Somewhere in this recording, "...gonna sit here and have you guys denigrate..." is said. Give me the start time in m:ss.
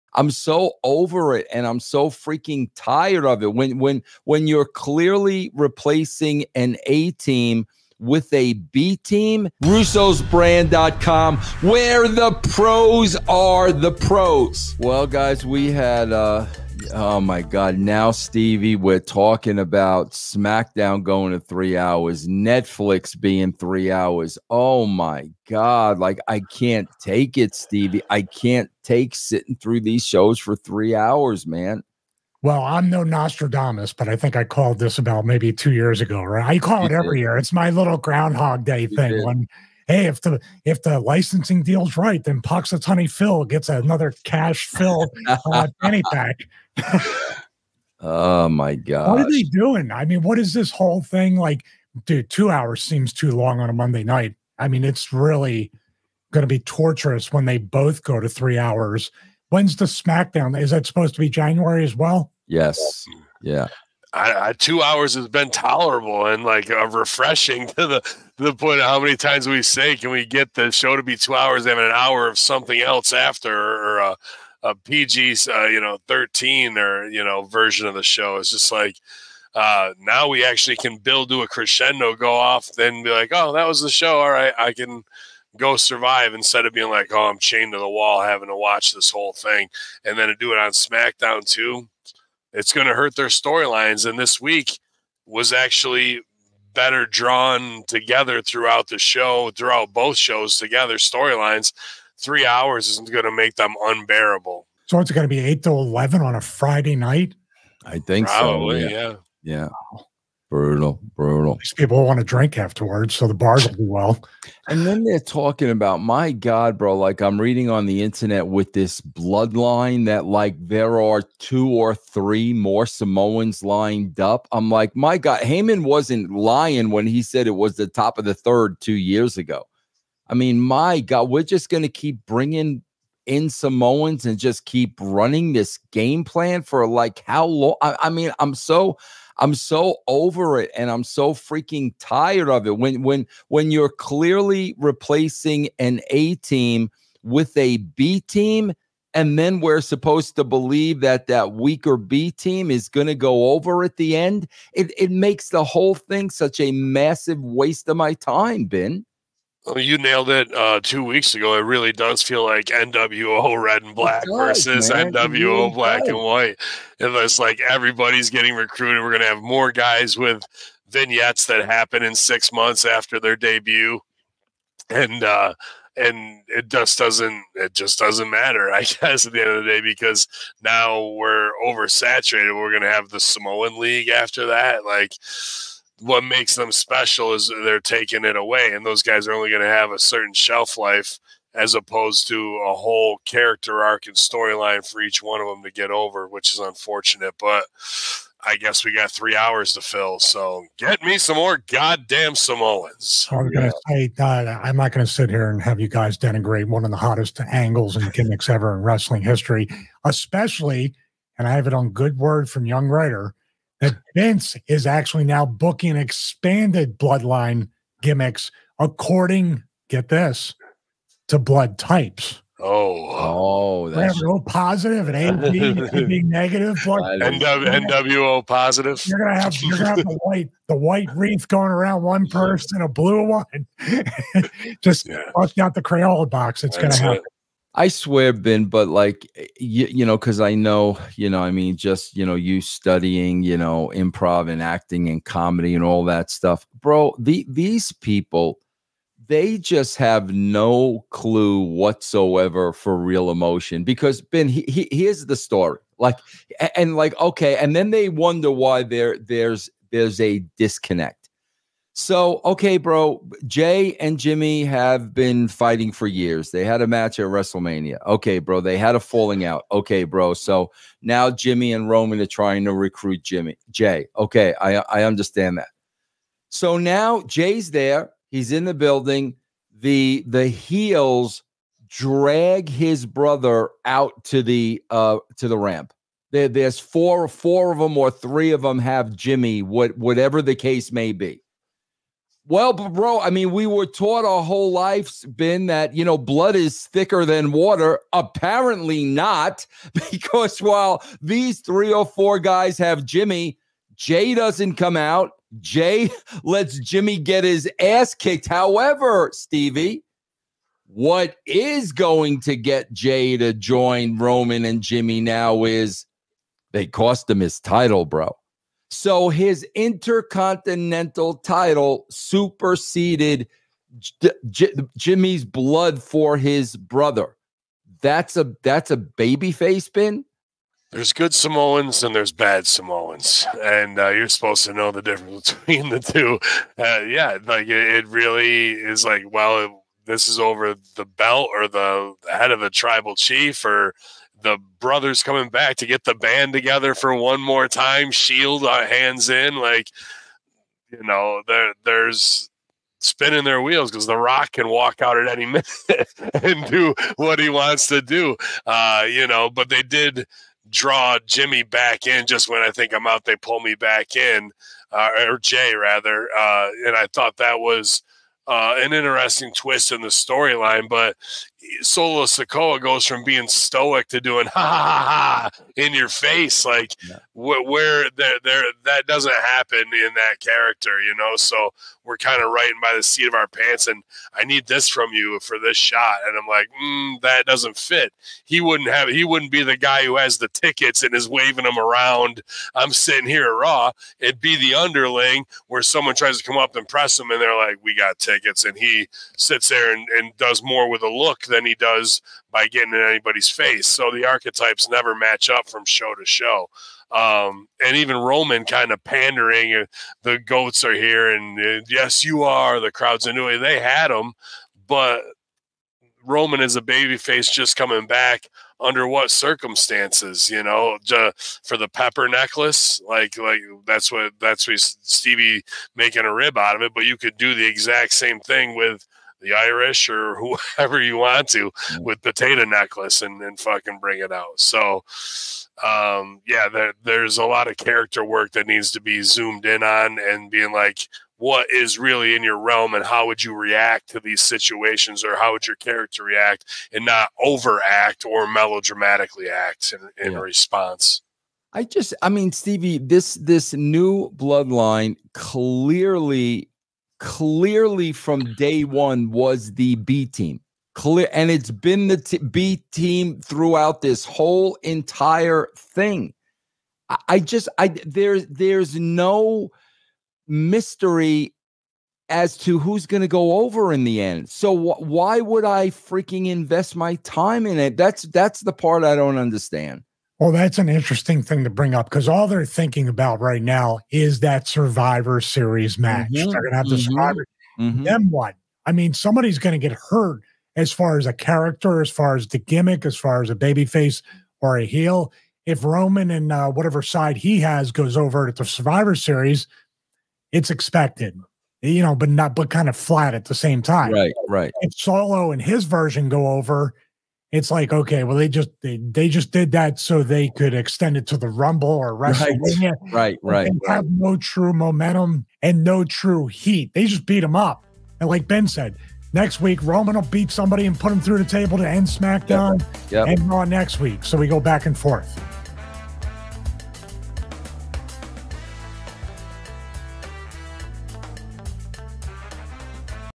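3:24.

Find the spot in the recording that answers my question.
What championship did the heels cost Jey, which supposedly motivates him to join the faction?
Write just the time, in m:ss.
5:19.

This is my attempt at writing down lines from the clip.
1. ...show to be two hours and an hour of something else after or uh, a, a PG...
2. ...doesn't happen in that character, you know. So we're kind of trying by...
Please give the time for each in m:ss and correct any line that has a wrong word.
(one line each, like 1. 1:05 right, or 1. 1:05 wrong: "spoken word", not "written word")
1. 1:10 right
2. 6:19 wrong: "writing", not "trying".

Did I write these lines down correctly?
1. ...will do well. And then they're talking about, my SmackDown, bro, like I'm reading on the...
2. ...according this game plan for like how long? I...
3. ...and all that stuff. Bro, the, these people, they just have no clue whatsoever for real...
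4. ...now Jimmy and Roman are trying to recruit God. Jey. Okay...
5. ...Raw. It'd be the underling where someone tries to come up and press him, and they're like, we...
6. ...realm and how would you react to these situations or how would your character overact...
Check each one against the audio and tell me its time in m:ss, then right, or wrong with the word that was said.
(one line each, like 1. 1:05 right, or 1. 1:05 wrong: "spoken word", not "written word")
1. 1:53 wrong: "God", not "SmackDown"
2. 2:14 wrong: "running", not "according"
3. 4:05 right
4. 4:31 wrong: "Jimmy", not "God"
5. 6:33 right
6. 7:22 wrong: "react", not "overact".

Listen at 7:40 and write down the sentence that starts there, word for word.
Clear, and it's been the t- B team throughout this whole entire thing.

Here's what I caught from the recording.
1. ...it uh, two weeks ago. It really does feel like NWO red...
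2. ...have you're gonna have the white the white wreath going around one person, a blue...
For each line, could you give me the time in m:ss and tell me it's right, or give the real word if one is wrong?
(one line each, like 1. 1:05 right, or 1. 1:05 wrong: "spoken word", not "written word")
1. 2:40 right
2. 3:49 right.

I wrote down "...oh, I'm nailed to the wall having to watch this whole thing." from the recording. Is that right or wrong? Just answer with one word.
wrong.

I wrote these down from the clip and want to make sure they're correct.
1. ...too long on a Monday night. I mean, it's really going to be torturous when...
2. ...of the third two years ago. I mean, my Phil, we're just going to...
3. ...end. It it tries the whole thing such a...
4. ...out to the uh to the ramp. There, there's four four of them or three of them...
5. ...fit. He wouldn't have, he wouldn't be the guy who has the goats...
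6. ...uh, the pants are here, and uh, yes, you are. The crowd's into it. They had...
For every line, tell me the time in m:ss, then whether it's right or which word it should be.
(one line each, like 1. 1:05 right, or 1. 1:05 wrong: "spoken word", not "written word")
1. 0:53 right
2. 2:08 wrong: "God", not "Phil"
3. 2:34 wrong: "makes", not "tries"
4. 4:43 right
5. 6:27 wrong: "tickets", not "goats"
6. 6:49 wrong: "goats", not "pants".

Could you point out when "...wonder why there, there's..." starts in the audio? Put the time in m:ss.
4:18.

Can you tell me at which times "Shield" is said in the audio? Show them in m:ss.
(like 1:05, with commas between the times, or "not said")
5:48.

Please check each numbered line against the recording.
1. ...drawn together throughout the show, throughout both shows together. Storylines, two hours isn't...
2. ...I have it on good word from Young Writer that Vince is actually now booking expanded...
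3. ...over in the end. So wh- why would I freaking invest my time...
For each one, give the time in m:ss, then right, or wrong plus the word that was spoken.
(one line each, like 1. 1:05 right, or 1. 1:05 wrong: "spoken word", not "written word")
1. 1:37 wrong: "three", not "two"
2. 3:31 right
3. 7:53 right.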